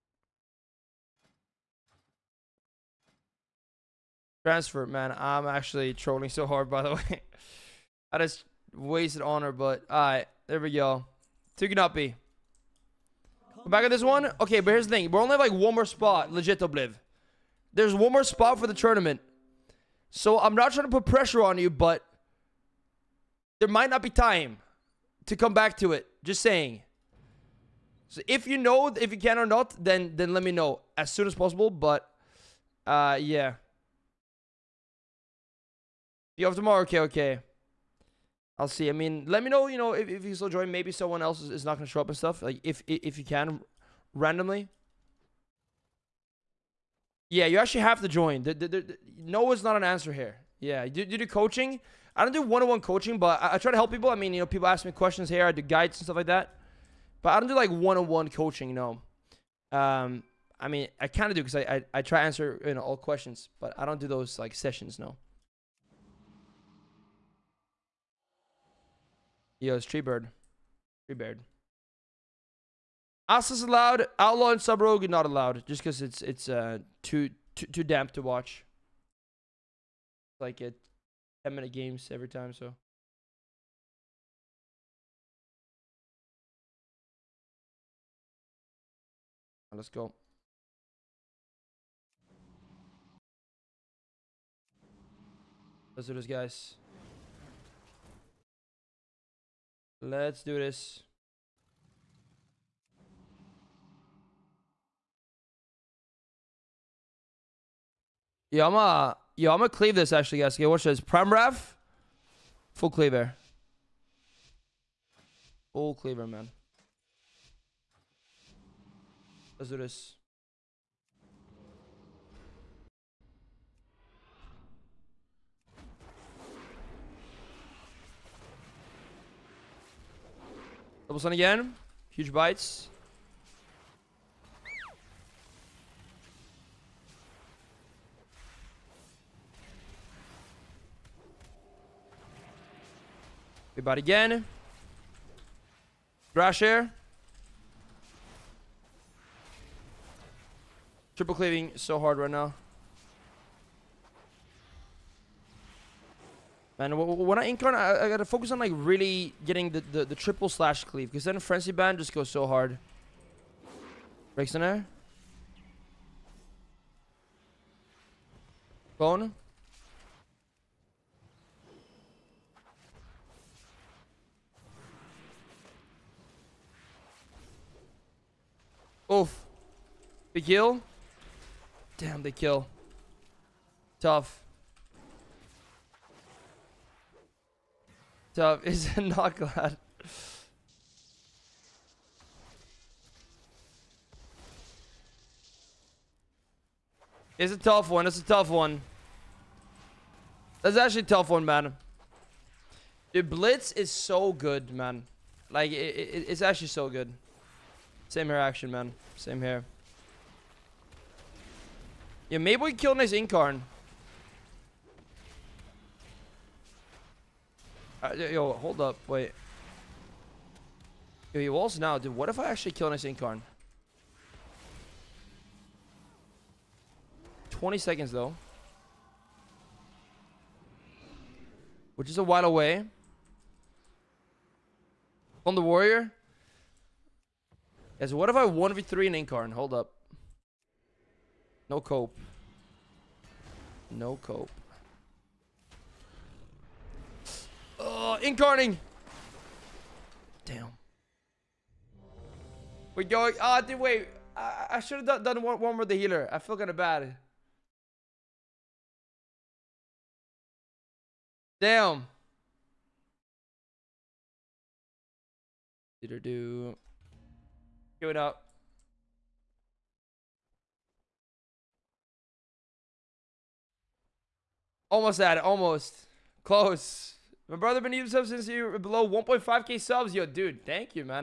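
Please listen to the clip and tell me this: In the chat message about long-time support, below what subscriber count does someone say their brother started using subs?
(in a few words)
1.5k.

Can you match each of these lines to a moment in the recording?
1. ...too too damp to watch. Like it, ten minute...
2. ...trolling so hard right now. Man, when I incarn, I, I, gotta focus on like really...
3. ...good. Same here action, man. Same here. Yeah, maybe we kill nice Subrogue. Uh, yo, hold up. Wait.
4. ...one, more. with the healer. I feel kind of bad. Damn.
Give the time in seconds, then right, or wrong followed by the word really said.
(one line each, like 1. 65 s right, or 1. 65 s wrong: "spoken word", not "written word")
1. 77 s right
2. 151 s wrong: "cleaving", not "trolling"
3. 206 s wrong: "Incarn", not "Subrogue"
4. 255 s right.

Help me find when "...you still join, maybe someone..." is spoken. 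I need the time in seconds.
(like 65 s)
40 s.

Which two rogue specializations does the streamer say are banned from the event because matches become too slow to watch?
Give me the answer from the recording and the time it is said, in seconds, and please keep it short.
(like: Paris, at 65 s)
Outlaw and Subrogue, at 74 s.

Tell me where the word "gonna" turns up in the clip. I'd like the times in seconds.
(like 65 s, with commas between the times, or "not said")
41 s, 108 s.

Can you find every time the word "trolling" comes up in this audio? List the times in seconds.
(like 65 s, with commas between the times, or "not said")
5 s.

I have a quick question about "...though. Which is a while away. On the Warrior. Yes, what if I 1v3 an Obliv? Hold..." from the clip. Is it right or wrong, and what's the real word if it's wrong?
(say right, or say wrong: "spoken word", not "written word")
wrong: "Incarn", not "Obliv".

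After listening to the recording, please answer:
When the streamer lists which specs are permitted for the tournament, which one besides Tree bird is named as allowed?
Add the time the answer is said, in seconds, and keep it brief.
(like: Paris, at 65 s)
Asus, at 73 s.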